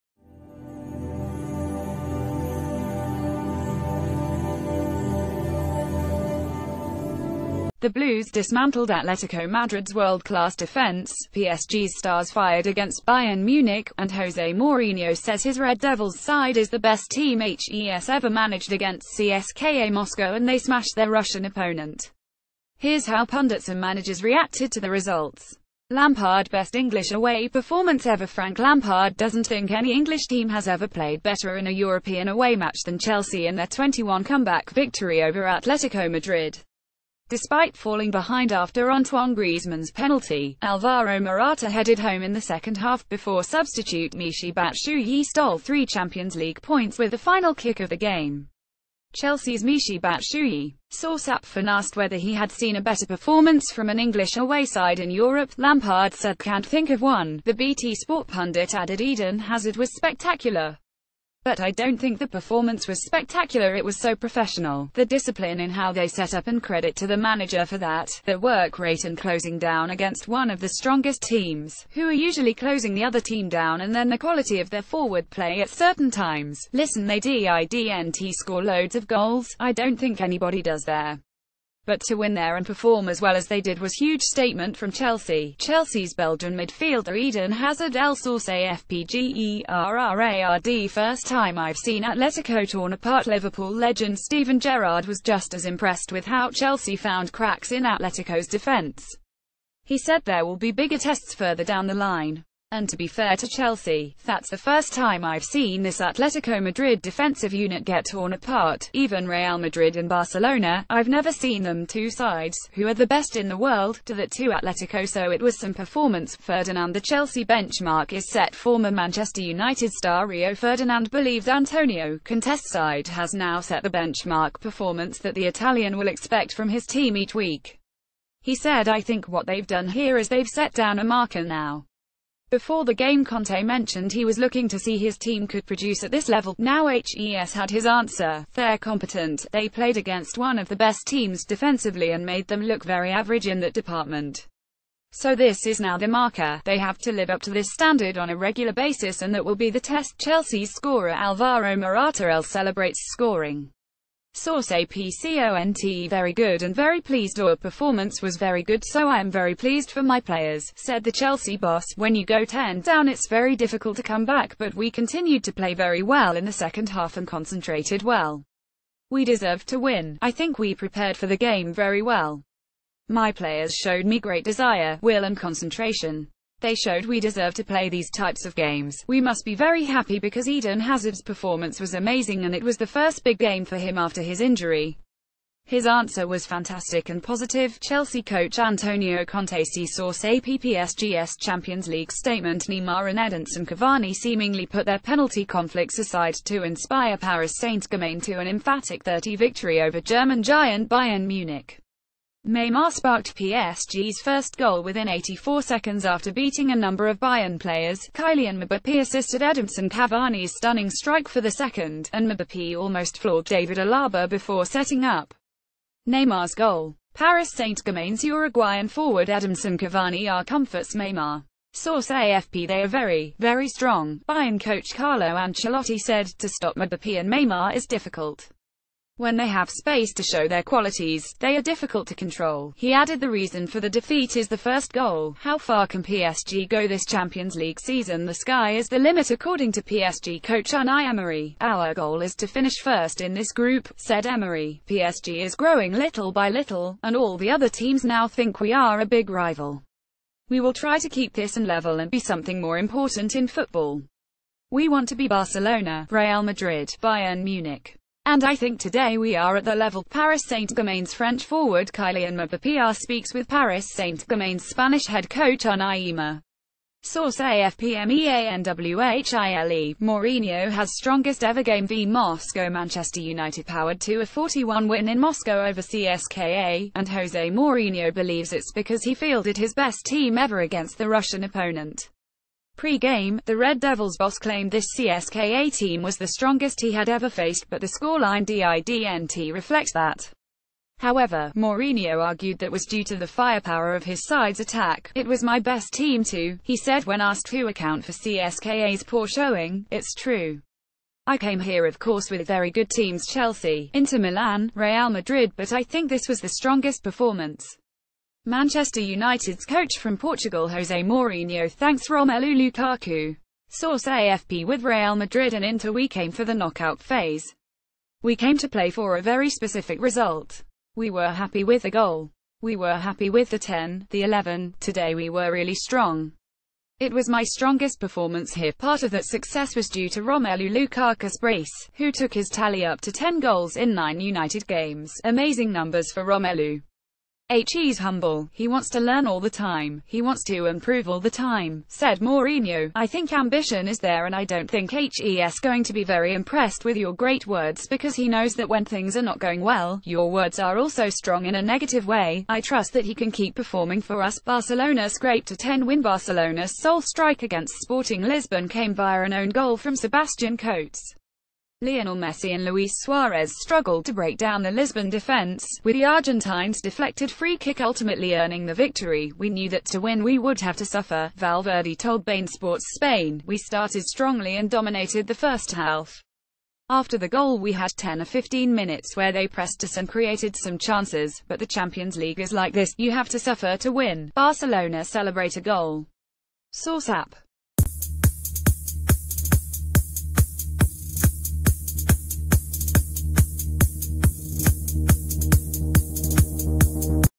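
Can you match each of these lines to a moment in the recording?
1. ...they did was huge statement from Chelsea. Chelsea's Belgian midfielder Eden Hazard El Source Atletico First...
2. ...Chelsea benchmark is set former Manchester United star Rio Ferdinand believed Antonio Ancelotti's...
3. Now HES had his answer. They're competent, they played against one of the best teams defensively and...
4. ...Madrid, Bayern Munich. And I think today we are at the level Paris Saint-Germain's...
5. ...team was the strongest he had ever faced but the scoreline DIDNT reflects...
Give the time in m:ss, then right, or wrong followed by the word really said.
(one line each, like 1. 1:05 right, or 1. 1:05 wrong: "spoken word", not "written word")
1. 1:23 wrong: "FPGERRARD", not "Atletico"
2. 1:57 wrong: "Conte", not "Ancelotti"
3. 2:16 right
4. 4:16 right
5. 4:45 right.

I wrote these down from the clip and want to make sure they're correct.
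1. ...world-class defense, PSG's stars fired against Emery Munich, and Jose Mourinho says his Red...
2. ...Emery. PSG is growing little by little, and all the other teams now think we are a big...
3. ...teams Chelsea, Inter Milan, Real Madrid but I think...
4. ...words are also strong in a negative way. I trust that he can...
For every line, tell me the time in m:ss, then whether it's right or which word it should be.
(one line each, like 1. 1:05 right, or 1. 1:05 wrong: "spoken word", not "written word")
1. 0:09 wrong: "Bayern", not "Emery"
2. 4:04 right
3. 5:02 right
4. 5:50 right.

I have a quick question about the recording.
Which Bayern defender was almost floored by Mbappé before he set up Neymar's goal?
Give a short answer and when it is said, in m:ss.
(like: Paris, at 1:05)
David Alaba, at 3:33.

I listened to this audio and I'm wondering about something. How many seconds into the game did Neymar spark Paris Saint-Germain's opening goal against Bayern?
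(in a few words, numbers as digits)
84.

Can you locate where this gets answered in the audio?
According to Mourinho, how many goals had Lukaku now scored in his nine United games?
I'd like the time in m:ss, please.
5:33.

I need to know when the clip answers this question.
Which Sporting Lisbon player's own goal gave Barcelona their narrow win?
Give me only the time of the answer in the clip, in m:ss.
5:59.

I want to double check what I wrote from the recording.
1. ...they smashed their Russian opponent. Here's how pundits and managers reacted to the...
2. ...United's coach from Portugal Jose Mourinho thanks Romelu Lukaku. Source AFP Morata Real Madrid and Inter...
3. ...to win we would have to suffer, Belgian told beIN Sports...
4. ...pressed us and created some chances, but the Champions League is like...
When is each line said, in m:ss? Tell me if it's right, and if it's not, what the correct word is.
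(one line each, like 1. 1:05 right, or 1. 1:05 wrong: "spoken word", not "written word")
1. 0:20 right
2. 5:09 wrong: "With", not "Morata"
3. 6:09 wrong: "Valverde", not "Belgian"
4. 6:19 right.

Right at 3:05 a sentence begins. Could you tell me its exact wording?
His answer was fantastic and positive.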